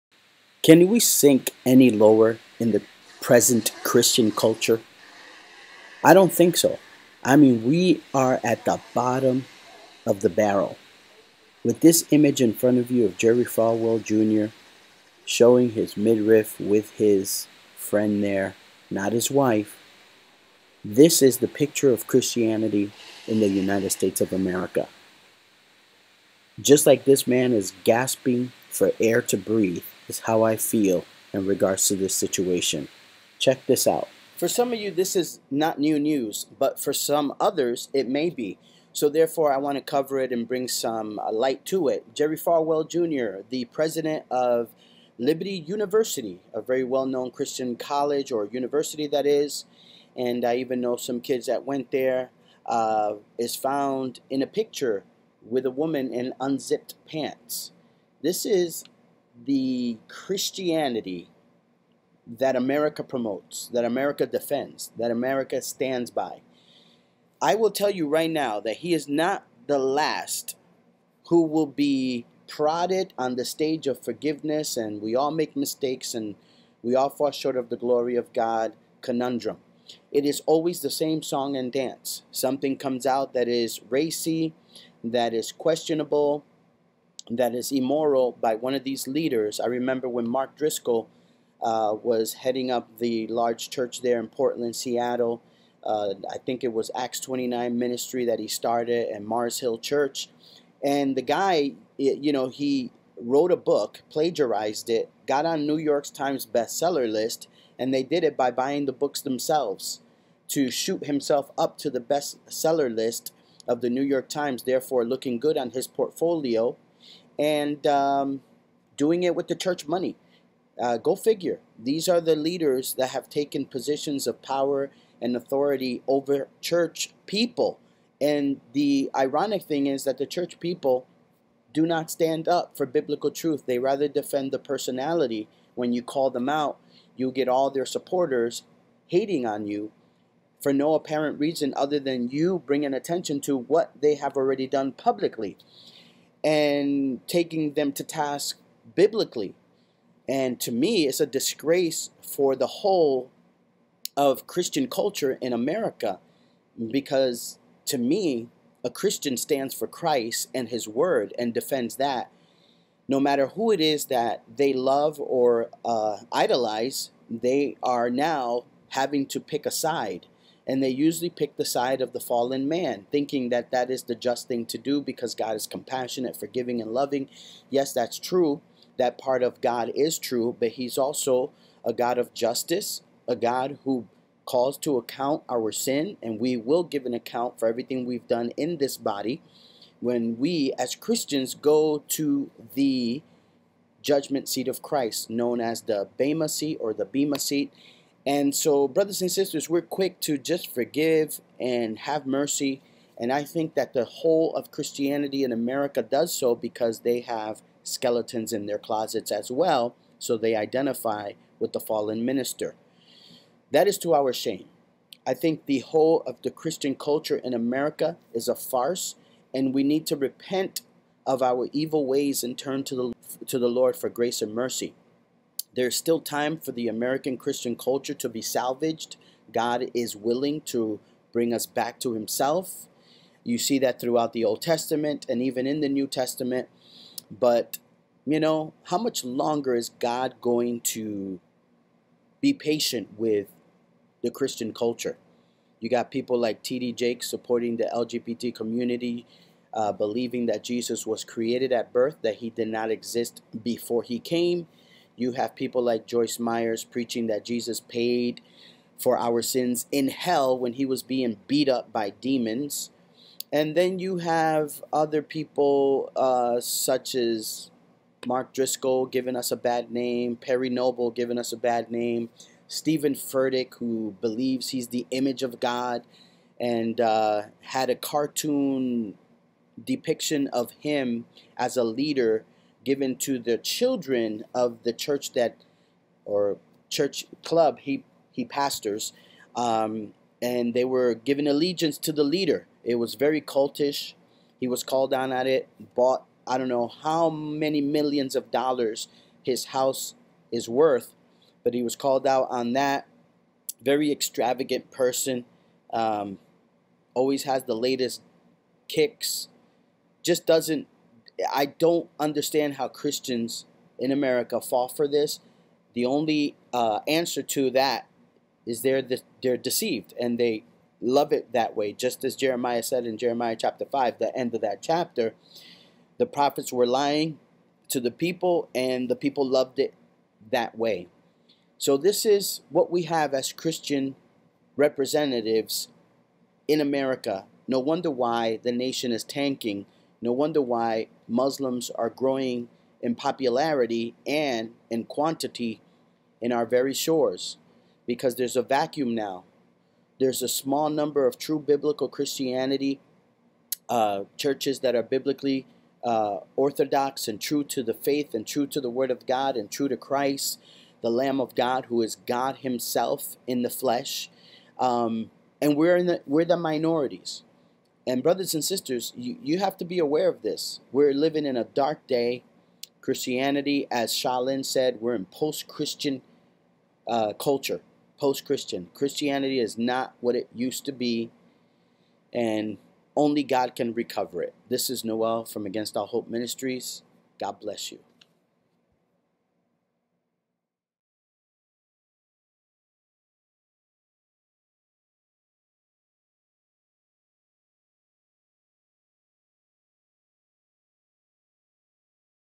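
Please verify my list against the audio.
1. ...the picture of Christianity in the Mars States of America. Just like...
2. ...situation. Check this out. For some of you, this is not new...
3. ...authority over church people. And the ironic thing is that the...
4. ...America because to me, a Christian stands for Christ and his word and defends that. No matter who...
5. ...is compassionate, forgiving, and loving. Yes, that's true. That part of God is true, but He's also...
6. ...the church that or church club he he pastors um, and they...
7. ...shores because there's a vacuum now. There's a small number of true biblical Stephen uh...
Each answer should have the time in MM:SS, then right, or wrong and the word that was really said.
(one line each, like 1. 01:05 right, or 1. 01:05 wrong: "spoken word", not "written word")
1. 00:21 wrong: "United", not "Mars"
2. 00:32 right
3. 02:05 right
4. 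02:35 right
5. 02:55 right
6. 04:44 right
7. 05:46 wrong: "Christianity", not "Stephen".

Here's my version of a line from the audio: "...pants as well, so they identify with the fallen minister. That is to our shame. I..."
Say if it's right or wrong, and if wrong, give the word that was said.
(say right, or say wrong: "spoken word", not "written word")
wrong: "closets", not "pants".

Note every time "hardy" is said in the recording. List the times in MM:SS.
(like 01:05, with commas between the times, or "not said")
not said.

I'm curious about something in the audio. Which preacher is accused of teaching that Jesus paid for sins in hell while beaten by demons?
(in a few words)
Joyce Myers.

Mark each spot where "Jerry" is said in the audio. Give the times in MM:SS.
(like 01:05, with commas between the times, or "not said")
00:13, 00:42.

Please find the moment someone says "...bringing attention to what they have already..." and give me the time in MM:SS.
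02:22.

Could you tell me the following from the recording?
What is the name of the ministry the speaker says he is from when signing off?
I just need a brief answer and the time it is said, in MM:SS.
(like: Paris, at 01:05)
Against All Hope Ministries, at 06:25.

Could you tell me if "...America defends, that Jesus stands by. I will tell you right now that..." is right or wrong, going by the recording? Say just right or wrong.
wrong.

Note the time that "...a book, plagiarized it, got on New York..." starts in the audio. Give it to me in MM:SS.
01:43.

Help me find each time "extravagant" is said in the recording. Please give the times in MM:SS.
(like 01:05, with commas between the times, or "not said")
05:04.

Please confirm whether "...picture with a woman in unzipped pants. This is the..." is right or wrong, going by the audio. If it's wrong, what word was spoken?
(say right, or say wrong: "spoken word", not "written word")
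right.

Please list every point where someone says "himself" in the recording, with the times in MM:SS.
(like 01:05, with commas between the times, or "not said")
01:51, 03:52, 06:02.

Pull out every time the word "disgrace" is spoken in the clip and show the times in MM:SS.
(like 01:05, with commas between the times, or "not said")
02:31.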